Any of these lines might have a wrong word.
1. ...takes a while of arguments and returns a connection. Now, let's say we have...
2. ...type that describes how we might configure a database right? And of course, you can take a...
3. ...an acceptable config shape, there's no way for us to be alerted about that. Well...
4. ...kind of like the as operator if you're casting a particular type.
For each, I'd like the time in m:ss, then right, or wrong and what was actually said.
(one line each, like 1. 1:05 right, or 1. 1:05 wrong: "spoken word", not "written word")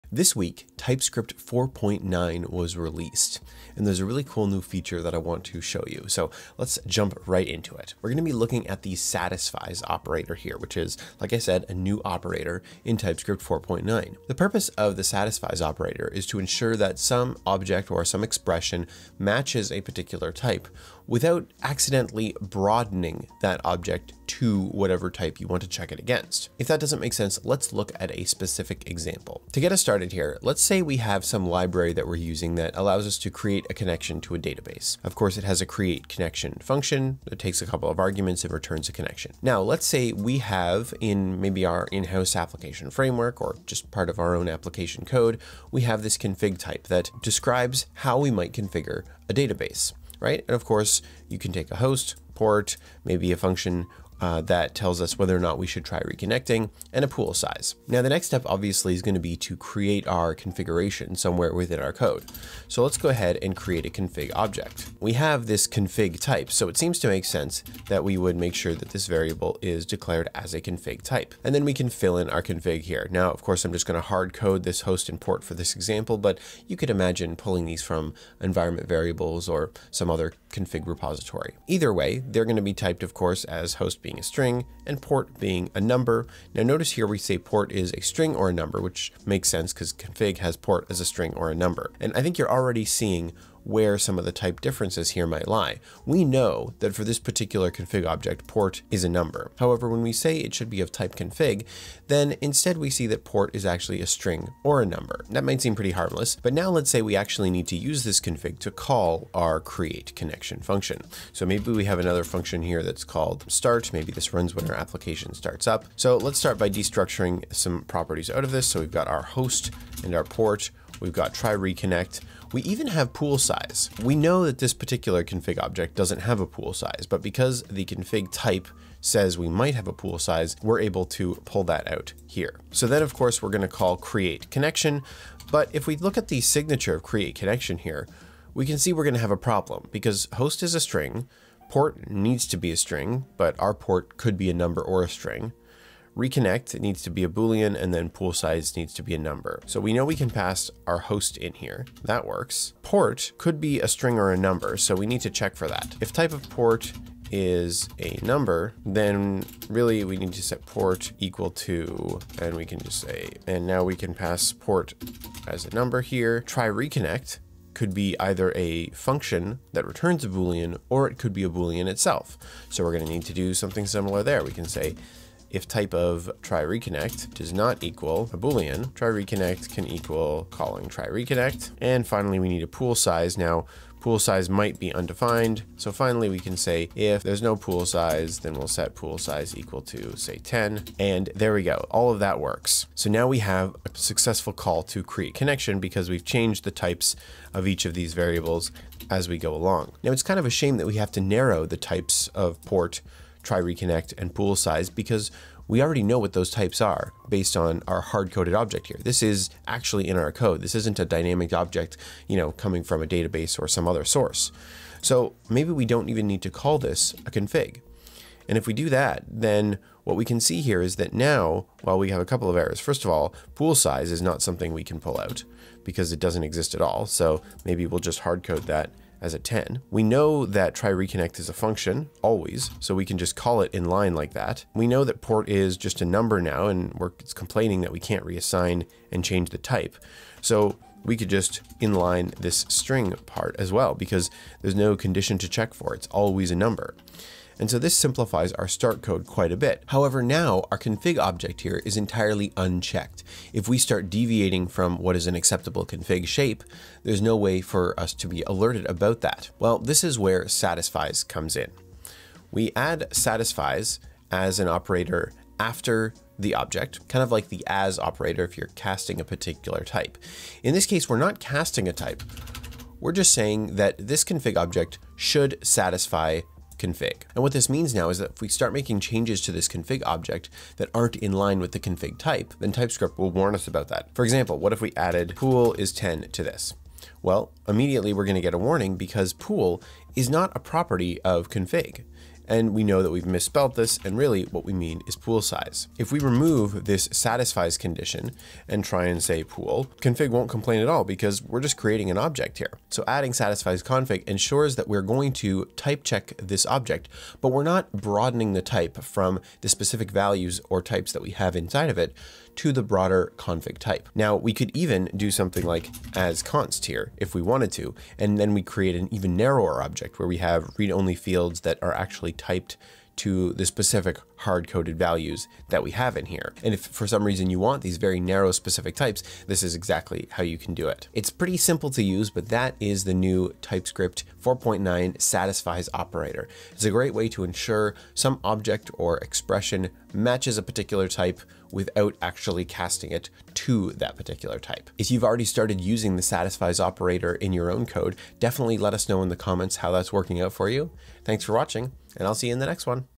1. 0:37 wrong: "couple", not "while"
2. 0:46 right
3. 4:15 right
4. 4:27 right.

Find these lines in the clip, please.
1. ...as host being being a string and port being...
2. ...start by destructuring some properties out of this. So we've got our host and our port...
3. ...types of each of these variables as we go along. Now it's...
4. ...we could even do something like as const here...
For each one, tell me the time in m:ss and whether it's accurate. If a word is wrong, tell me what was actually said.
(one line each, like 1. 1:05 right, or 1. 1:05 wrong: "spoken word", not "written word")
1. 1:23 right
2. 1:56 right
3. 3:16 right
4. 5:14 right.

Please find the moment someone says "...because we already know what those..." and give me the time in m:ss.
3:24.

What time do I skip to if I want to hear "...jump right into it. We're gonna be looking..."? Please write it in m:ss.
0:06.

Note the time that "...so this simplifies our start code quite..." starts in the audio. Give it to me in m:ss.
4:07.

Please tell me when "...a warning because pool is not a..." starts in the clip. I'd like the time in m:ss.
4:48.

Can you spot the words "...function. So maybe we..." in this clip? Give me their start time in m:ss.
1:50.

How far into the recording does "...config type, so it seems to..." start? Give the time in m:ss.
1:05.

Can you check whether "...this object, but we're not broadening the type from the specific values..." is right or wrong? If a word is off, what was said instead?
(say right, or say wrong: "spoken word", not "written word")
right.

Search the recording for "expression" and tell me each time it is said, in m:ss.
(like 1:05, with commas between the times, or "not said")
0:18, 5:39.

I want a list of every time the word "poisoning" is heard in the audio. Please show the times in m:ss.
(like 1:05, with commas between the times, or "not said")
not said.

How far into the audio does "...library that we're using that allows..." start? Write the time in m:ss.
0:31.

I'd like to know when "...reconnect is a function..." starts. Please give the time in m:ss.
3:50.